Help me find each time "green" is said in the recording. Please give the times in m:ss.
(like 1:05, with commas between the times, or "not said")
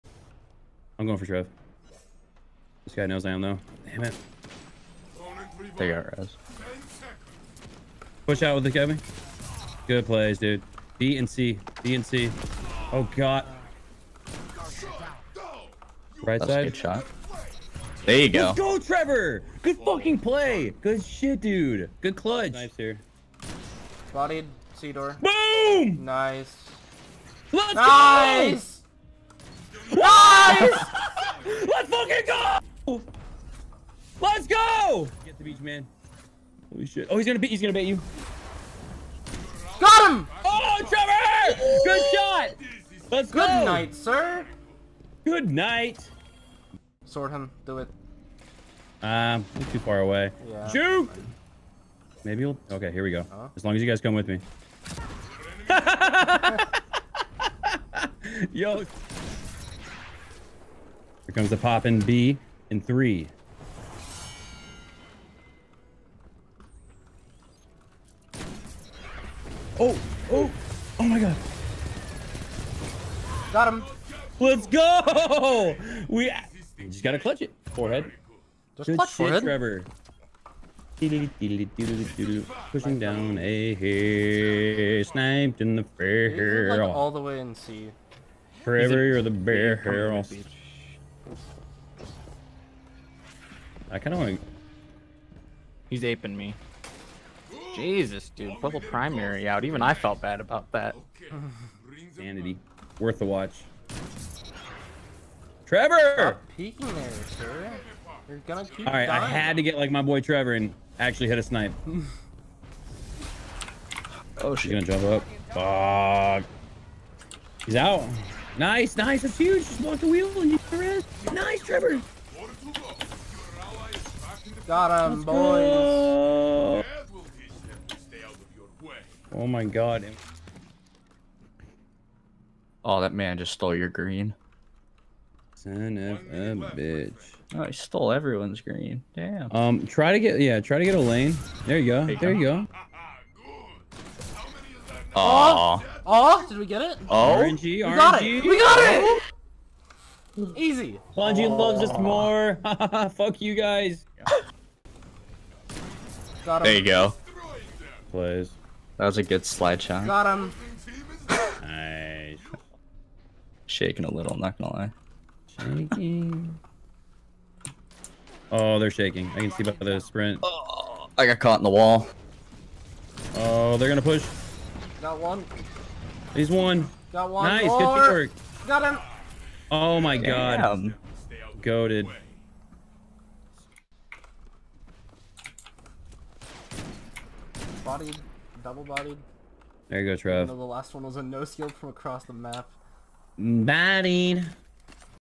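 2:13, 2:18.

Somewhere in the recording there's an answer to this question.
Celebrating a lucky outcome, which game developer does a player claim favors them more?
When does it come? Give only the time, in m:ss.
2:31.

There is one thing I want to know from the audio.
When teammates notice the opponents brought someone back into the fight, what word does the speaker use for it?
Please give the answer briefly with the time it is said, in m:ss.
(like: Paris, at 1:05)
res, at 0:05.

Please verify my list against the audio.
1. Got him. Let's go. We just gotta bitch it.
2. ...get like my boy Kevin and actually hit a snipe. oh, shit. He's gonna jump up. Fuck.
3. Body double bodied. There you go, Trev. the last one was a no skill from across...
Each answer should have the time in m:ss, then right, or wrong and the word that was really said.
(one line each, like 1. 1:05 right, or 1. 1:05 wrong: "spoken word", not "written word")
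1. 1:13 wrong: "clutch", not "bitch"
2. 1:49 wrong: "Trevor", not "Kevin"
3. 3:07 right.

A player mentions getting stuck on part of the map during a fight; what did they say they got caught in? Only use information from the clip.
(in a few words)
the wall.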